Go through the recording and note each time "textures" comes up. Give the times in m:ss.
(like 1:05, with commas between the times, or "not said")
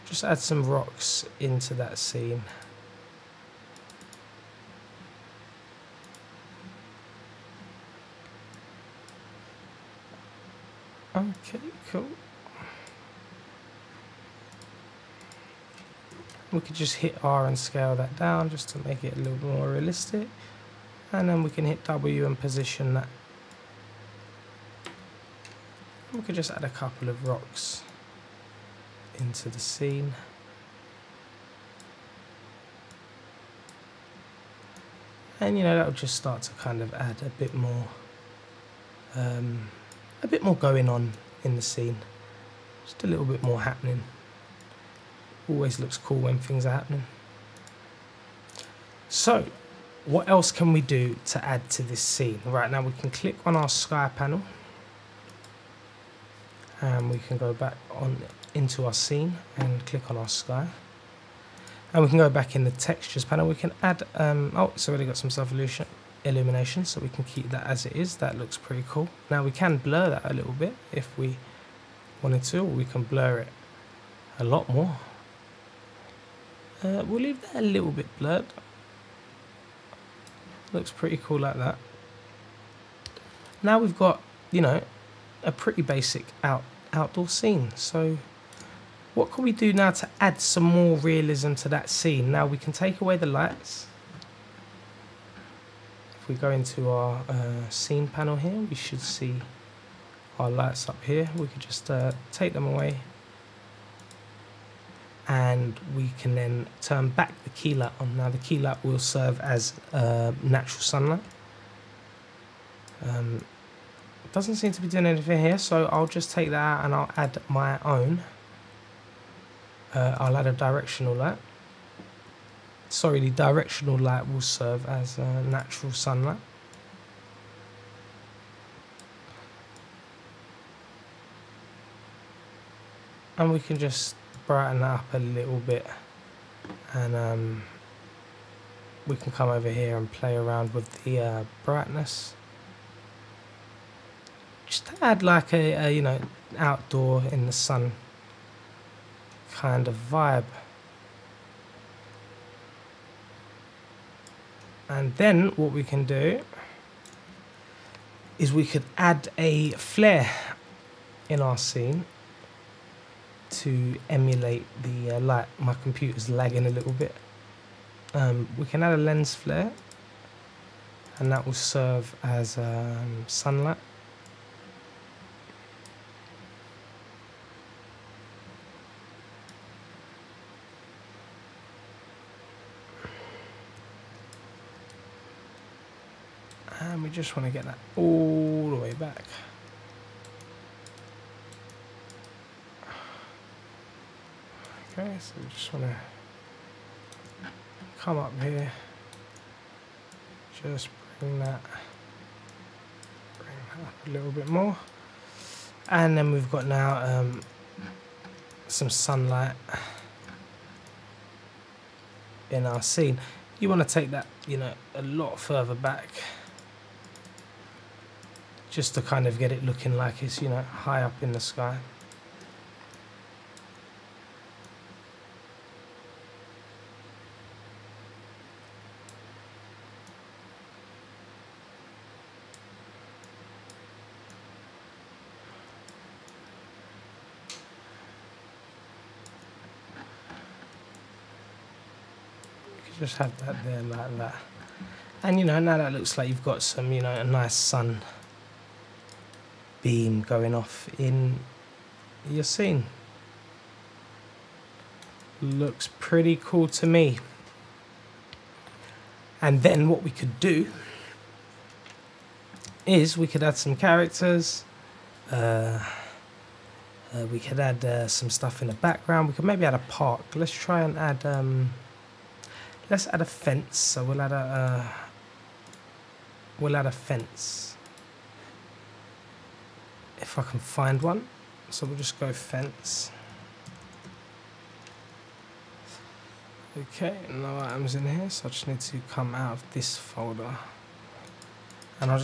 1:02.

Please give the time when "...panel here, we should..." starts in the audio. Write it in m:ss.
1:38.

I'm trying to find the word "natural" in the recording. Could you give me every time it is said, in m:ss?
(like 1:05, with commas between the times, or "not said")
1:50, 2:05.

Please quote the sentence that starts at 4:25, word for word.
Uh, uh, we could add uh, some stuff in the background.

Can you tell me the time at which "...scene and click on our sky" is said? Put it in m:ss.
0:58.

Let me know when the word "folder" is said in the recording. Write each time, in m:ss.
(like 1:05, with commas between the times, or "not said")
4:49.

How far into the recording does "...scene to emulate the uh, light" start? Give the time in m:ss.
2:41.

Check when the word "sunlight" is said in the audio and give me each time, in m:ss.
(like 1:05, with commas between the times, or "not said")
1:50, 2:05, 2:53, 3:28.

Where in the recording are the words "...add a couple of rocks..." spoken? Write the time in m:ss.
0:26.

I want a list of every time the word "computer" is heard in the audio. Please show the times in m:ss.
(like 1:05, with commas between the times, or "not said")
2:45.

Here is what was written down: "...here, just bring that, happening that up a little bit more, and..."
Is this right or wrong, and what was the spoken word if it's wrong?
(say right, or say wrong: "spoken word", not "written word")
wrong: "bring", not "happening".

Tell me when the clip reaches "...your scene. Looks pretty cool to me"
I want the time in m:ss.
4:12.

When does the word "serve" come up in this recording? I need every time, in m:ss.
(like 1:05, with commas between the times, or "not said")
1:48, 2:04, 2:51.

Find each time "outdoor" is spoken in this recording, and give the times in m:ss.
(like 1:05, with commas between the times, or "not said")
1:26, 2:26.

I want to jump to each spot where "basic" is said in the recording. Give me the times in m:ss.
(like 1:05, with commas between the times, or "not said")
1:25.